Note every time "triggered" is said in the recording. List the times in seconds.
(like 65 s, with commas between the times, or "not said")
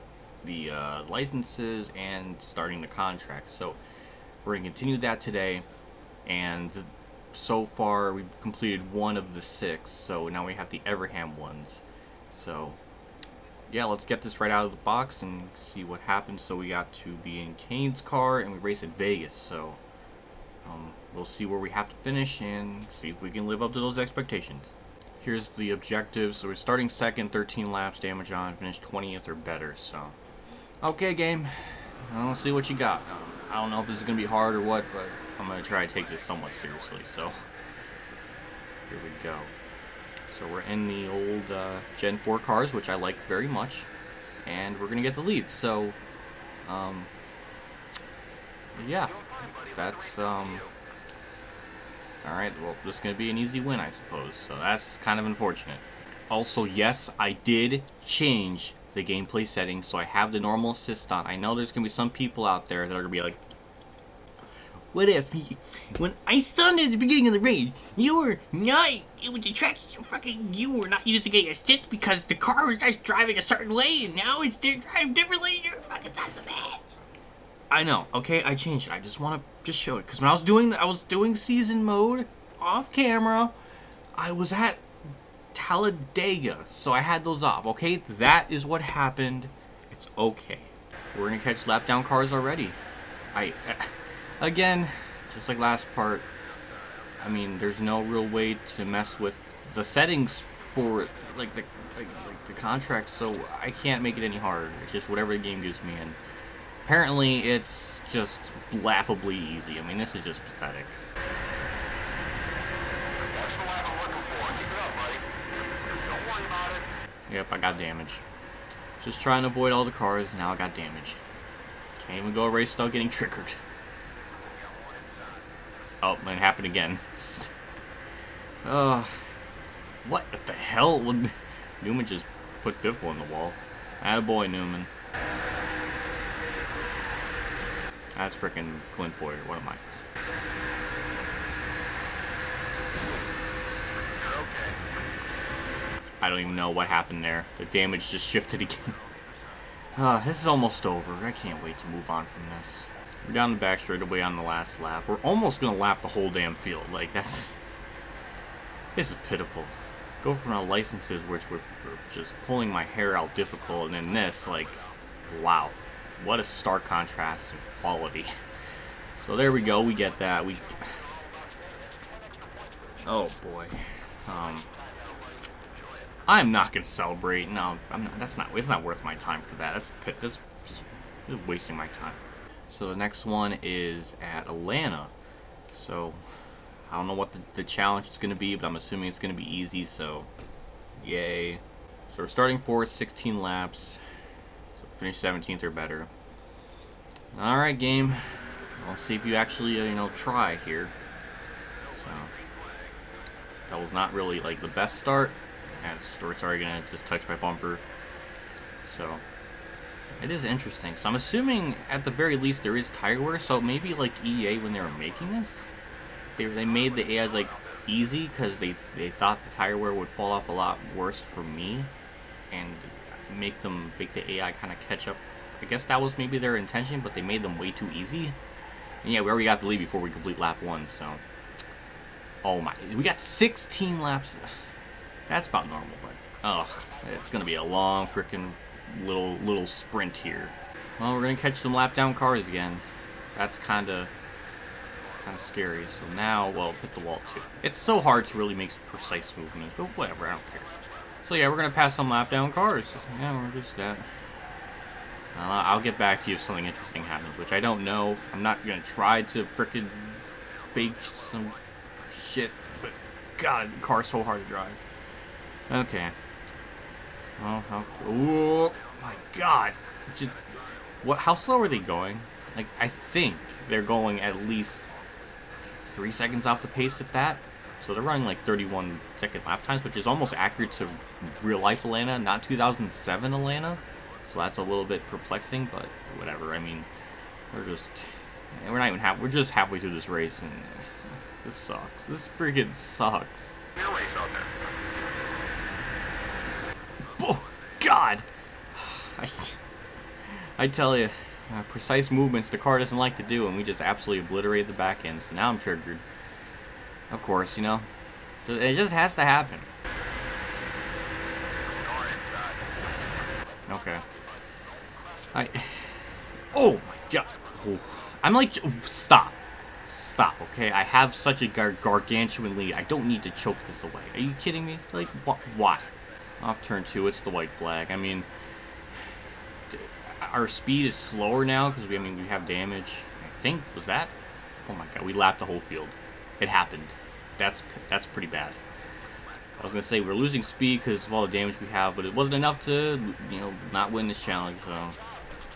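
123 s, 305 s.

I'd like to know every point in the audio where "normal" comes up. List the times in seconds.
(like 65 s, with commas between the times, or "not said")
60 s, 235 s.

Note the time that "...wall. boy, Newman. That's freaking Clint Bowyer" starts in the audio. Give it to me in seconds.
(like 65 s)
133 s.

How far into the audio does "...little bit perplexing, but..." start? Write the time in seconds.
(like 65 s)
284 s.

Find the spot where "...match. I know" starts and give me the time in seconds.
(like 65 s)
76 s.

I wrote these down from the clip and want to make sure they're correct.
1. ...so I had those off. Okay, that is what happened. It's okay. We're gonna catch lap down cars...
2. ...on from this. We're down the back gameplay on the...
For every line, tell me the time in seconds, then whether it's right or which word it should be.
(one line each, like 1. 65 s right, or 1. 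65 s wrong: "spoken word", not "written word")
1. 86 s right
2. 152 s wrong: "straightaway", not "gameplay".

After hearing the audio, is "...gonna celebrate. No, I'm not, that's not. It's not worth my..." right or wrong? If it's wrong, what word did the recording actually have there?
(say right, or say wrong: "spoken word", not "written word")
right.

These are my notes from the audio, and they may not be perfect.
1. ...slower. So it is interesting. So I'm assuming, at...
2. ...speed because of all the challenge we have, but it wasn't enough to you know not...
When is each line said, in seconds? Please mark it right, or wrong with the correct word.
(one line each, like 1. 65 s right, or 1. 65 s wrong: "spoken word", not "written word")
1. 207 s wrong: "bumper", not "slower"
2. 340 s wrong: "damage", not "challenge".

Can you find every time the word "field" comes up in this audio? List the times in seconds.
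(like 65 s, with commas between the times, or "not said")
156 s, 335 s.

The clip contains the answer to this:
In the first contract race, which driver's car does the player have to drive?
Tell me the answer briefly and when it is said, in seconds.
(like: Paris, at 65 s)
Kahne, at 17 s.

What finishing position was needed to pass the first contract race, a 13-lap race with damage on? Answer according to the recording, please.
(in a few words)
20th.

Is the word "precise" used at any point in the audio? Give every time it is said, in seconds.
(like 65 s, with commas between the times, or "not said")
248 s, 301 s.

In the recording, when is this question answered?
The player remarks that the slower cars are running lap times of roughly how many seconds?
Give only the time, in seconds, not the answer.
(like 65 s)
278 s.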